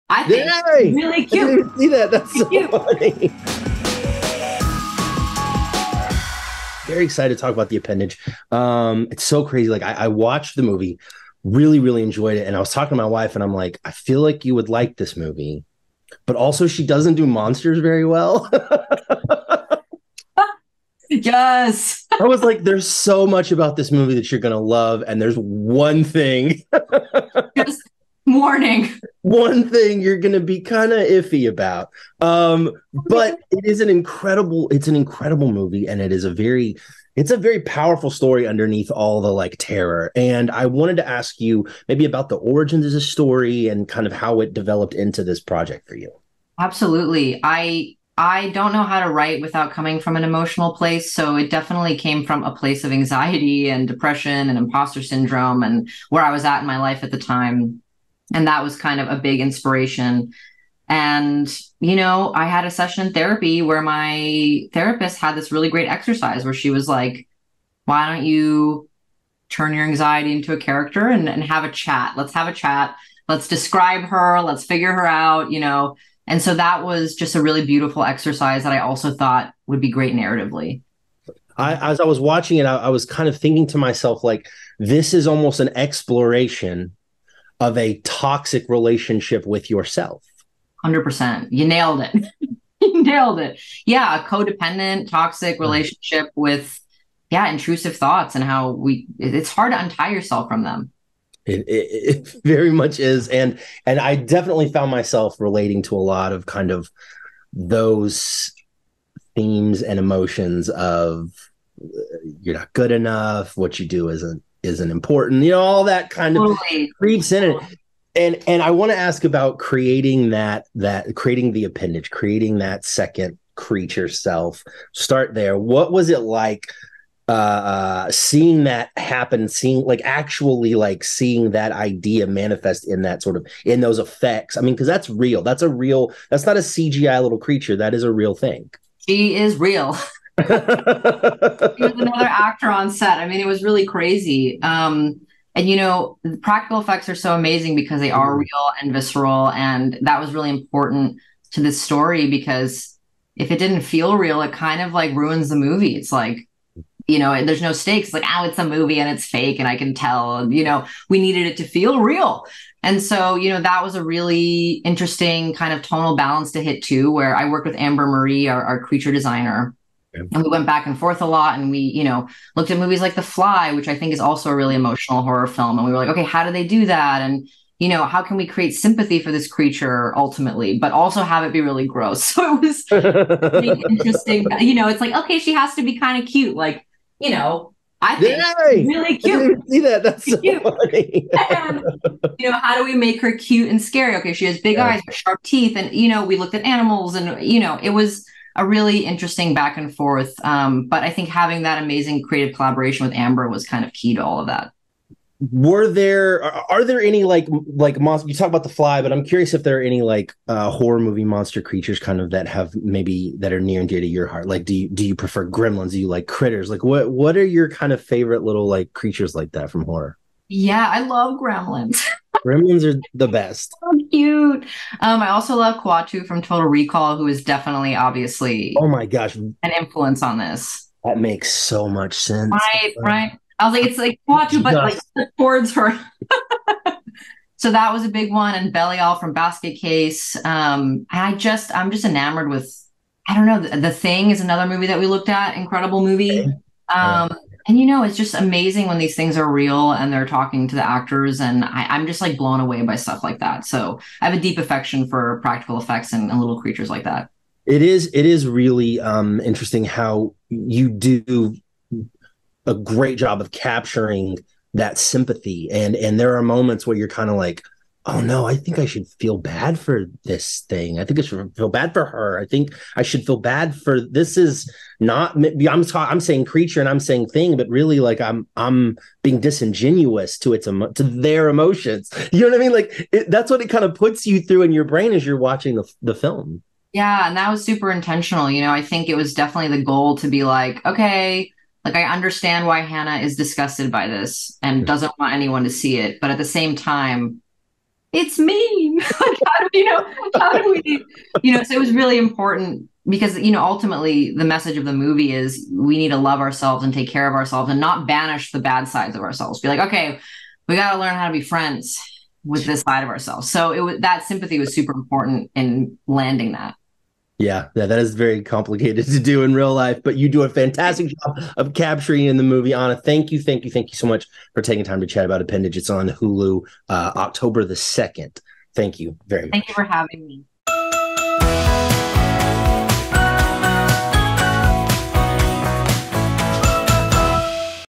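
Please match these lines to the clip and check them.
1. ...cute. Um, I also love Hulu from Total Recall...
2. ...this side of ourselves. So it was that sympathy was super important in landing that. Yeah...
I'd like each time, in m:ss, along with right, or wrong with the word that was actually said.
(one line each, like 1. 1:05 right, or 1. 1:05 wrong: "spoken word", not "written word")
1. 3:44 wrong: "Kuato", not "Hulu"
2. 5:12 right.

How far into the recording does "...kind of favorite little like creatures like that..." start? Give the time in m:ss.
3:37.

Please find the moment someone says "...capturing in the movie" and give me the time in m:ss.
5:21.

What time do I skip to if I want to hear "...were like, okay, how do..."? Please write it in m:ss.
2:55.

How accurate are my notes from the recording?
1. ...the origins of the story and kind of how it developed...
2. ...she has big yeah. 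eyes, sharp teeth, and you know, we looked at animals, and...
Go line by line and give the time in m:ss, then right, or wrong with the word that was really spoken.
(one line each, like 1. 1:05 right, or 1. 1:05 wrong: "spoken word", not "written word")
1. 0:42 right
2. 3:14 right.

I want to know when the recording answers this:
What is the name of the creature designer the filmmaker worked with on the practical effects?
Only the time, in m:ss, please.
2:47.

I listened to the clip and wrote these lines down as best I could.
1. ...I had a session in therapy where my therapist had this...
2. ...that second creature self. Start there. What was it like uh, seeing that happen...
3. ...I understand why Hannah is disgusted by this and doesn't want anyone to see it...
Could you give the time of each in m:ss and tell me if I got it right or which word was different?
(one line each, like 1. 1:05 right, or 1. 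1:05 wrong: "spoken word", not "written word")
1. 1:02 right
2. 2:02 right
3. 4:51 right.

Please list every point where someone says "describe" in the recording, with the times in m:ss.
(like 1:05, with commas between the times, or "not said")
1:13.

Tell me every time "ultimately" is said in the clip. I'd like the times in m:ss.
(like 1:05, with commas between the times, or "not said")
3:00, 5:03.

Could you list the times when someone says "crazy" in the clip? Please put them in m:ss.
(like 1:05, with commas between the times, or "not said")
0:09, 2:23.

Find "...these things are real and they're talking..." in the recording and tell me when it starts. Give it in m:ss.
4:08.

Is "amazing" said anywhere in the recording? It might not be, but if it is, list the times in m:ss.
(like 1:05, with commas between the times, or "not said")
2:27, 3:21, 4:08.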